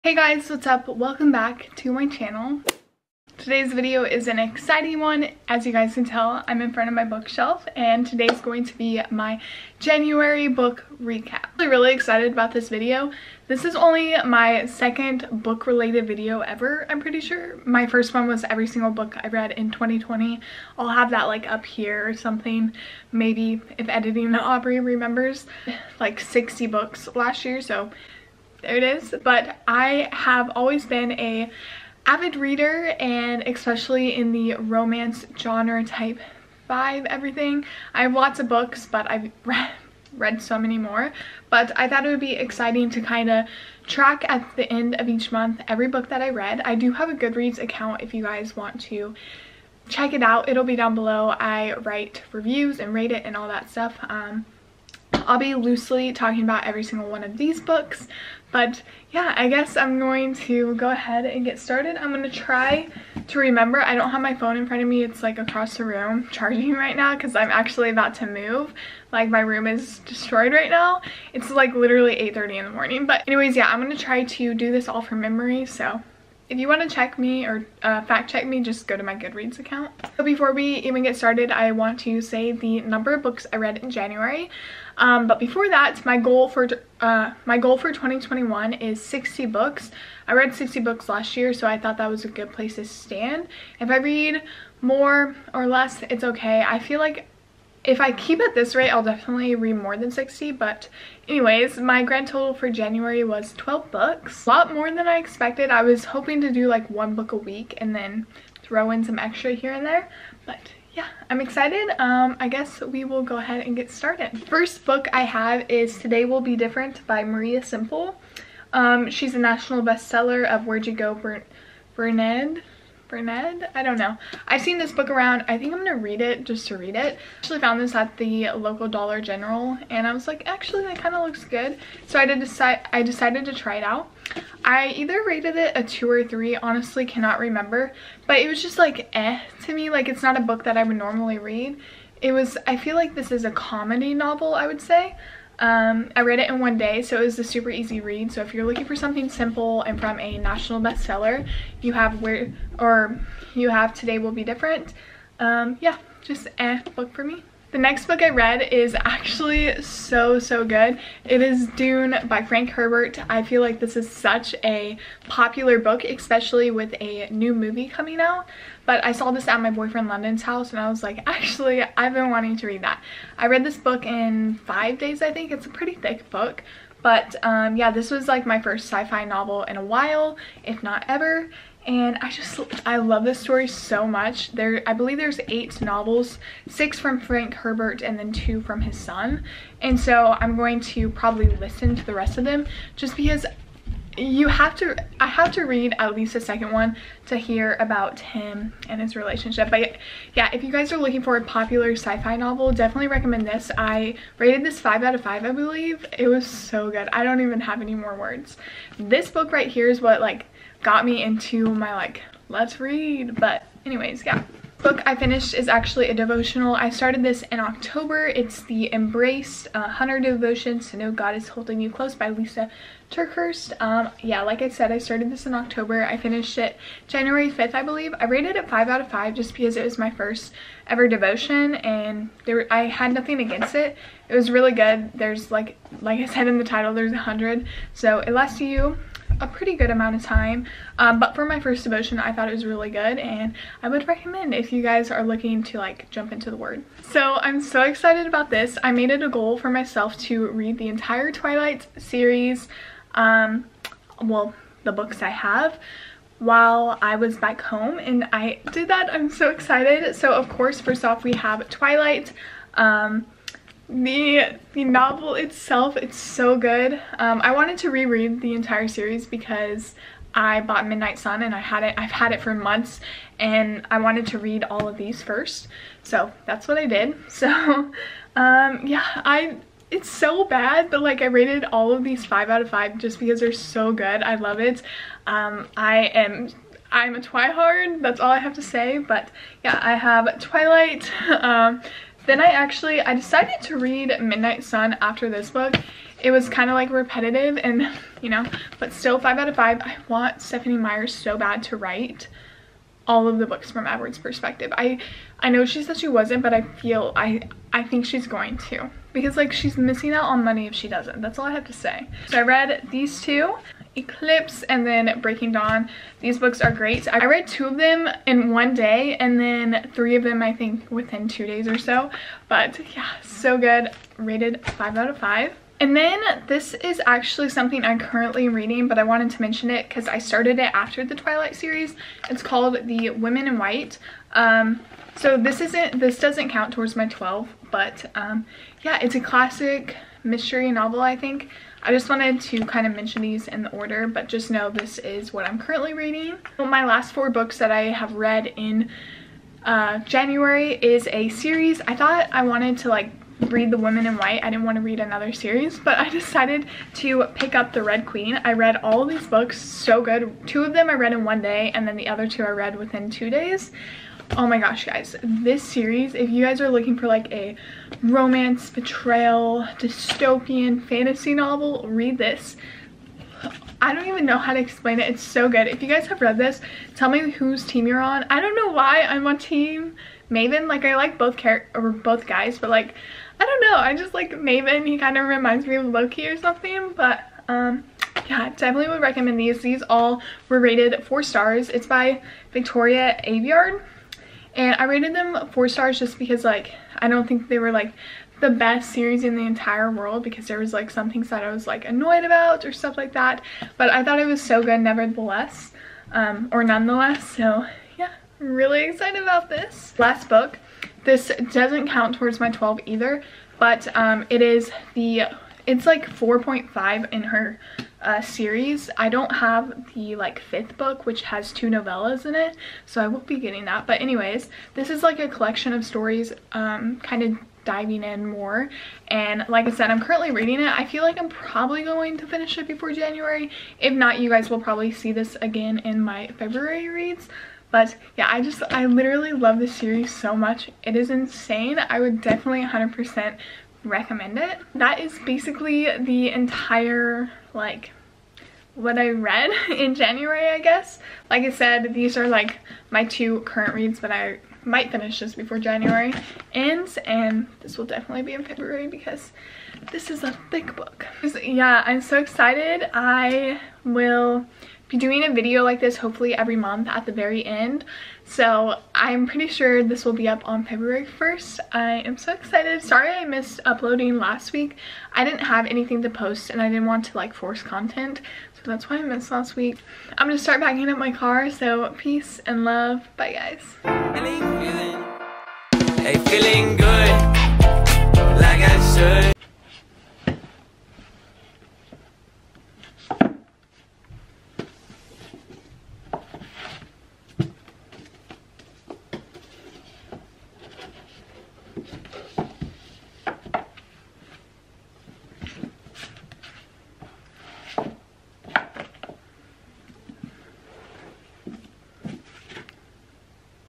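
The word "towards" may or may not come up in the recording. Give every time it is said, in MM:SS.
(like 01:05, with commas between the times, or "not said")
05:36, 06:52.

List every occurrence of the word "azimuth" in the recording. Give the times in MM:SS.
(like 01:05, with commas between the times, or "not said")
not said.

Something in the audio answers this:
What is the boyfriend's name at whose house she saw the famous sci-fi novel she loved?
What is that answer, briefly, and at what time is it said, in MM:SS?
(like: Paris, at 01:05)
London, at 02:50.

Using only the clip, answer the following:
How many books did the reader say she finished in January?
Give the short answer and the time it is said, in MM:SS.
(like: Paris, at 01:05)
12, at 01:43.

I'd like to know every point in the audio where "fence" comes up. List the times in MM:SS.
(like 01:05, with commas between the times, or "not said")
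not said.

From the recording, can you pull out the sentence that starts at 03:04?
There I believe there's eight novels, six from Frank Herbert and then two from his son.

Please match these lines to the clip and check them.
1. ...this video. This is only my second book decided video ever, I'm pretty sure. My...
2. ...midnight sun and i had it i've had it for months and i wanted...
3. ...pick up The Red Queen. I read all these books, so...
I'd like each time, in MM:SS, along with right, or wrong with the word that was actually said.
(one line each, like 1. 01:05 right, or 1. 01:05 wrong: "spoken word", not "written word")
1. 00:12 wrong: "related", not "decided"
2. 04:30 right
3. 05:57 right.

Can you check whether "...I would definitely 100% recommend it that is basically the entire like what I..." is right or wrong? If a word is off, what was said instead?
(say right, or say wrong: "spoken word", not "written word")
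right.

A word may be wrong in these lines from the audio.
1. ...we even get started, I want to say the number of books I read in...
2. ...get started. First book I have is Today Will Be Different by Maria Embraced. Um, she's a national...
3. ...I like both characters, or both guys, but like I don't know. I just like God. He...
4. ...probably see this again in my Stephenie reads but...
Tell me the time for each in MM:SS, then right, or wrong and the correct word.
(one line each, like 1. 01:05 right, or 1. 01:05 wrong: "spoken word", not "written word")
1. 01:20 right
2. 01:53 wrong: "Semple", not "Embraced"
3. 06:20 wrong: "Maven", not "God"
4. 07:14 wrong: "February", not "Stephenie".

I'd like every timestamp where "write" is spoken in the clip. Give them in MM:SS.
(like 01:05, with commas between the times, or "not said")
00:51, 05:01.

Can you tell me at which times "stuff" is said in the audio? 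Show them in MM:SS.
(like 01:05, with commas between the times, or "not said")
00:53, 06:42.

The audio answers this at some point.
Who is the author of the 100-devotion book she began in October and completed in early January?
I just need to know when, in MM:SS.
03:42.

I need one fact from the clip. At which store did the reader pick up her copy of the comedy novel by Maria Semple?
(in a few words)
Dollar General.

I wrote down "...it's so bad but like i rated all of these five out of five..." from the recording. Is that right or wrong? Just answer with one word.
right.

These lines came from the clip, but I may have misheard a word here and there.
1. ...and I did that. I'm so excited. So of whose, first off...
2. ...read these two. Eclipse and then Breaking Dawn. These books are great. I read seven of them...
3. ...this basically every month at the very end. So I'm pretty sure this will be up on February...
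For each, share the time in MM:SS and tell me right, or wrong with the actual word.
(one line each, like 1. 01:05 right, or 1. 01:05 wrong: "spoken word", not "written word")
1. 04:17 wrong: "course", not "whose"
2. 05:12 wrong: "two", not "seven"
3. 07:45 wrong: "hopefully", not "basically".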